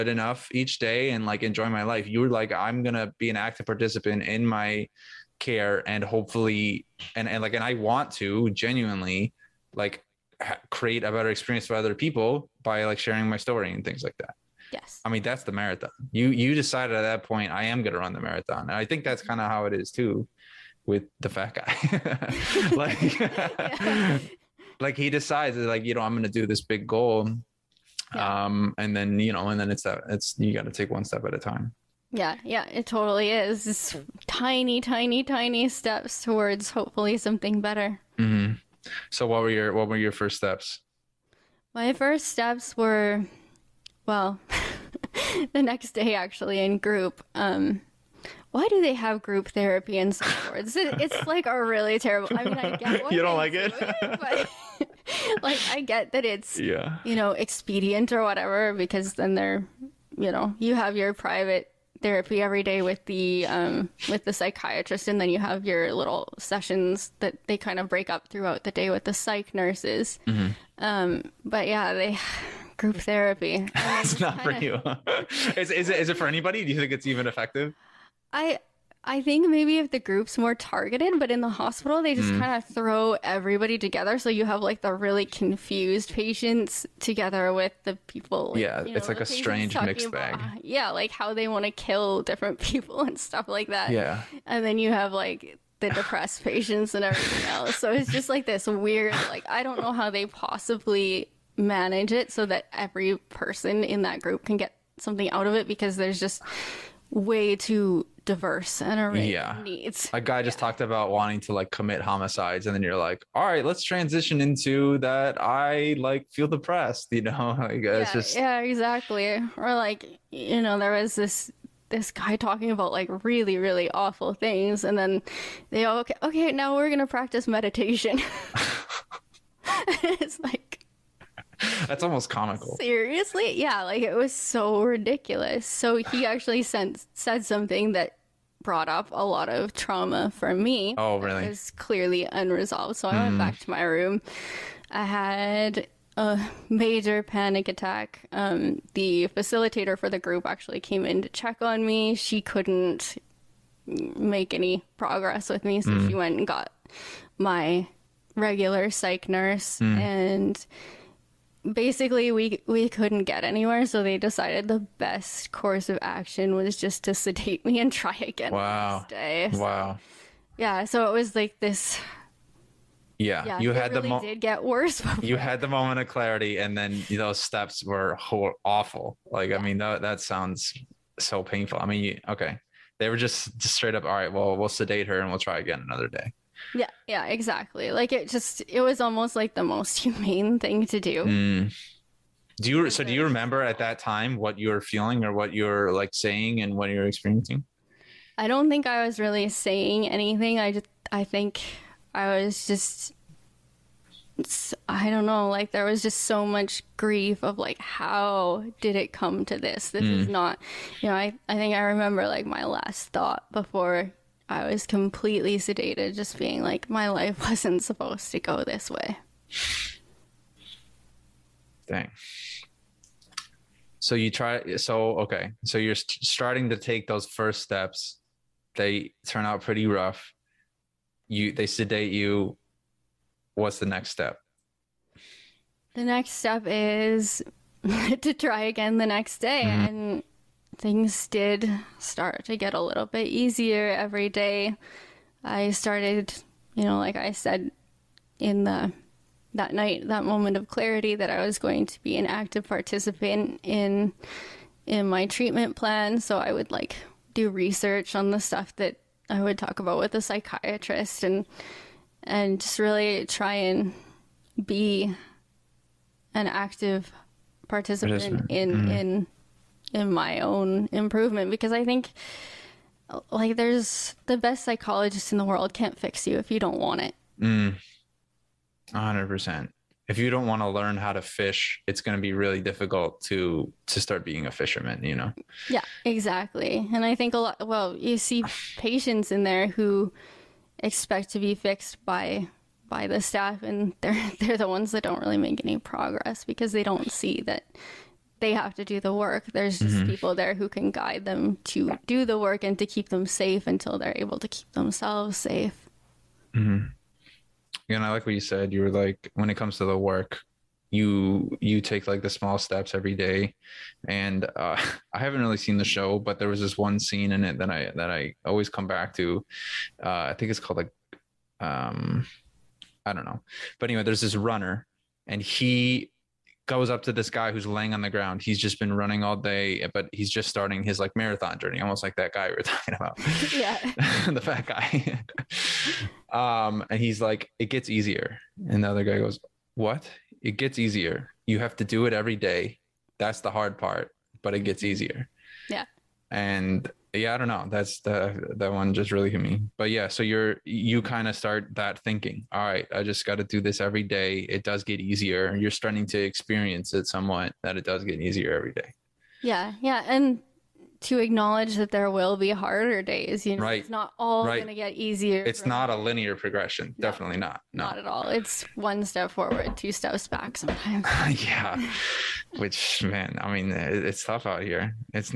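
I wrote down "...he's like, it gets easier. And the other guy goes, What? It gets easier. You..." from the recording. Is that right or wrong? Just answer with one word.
right.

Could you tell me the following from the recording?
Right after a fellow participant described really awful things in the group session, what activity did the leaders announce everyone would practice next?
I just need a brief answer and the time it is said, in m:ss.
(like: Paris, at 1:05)
Meditation, at 2:07.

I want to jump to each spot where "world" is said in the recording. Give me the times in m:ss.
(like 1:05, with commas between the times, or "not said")
4:35.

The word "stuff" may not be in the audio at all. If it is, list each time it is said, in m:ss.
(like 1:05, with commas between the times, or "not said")
1:33, 4:18.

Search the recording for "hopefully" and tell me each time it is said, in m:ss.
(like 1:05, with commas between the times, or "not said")
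0:06, 0:36.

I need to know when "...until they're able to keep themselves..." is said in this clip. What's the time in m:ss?
5:03.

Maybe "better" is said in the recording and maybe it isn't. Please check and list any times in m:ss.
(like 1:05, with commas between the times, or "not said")
0:11, 0:37.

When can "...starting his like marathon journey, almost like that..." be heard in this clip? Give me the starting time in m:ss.
5:30.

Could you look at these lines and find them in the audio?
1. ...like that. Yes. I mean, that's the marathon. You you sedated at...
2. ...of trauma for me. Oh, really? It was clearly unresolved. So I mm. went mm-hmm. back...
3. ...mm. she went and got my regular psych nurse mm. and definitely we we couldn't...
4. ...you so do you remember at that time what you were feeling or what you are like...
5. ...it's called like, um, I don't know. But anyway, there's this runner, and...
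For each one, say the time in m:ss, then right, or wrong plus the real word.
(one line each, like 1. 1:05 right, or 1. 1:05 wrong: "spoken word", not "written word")
1. 0:14 wrong: "decided", not "sedated"
2. 2:19 right
3. 2:35 wrong: "basically", not "definitely"
4. 3:12 right
5. 5:20 right.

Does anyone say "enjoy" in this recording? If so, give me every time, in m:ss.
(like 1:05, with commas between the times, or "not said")
0:01.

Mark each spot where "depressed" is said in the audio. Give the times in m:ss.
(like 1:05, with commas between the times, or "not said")
1:35, 1:56.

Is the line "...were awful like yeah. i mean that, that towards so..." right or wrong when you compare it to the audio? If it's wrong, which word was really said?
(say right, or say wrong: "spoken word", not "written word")
wrong: "sounds", not "towards".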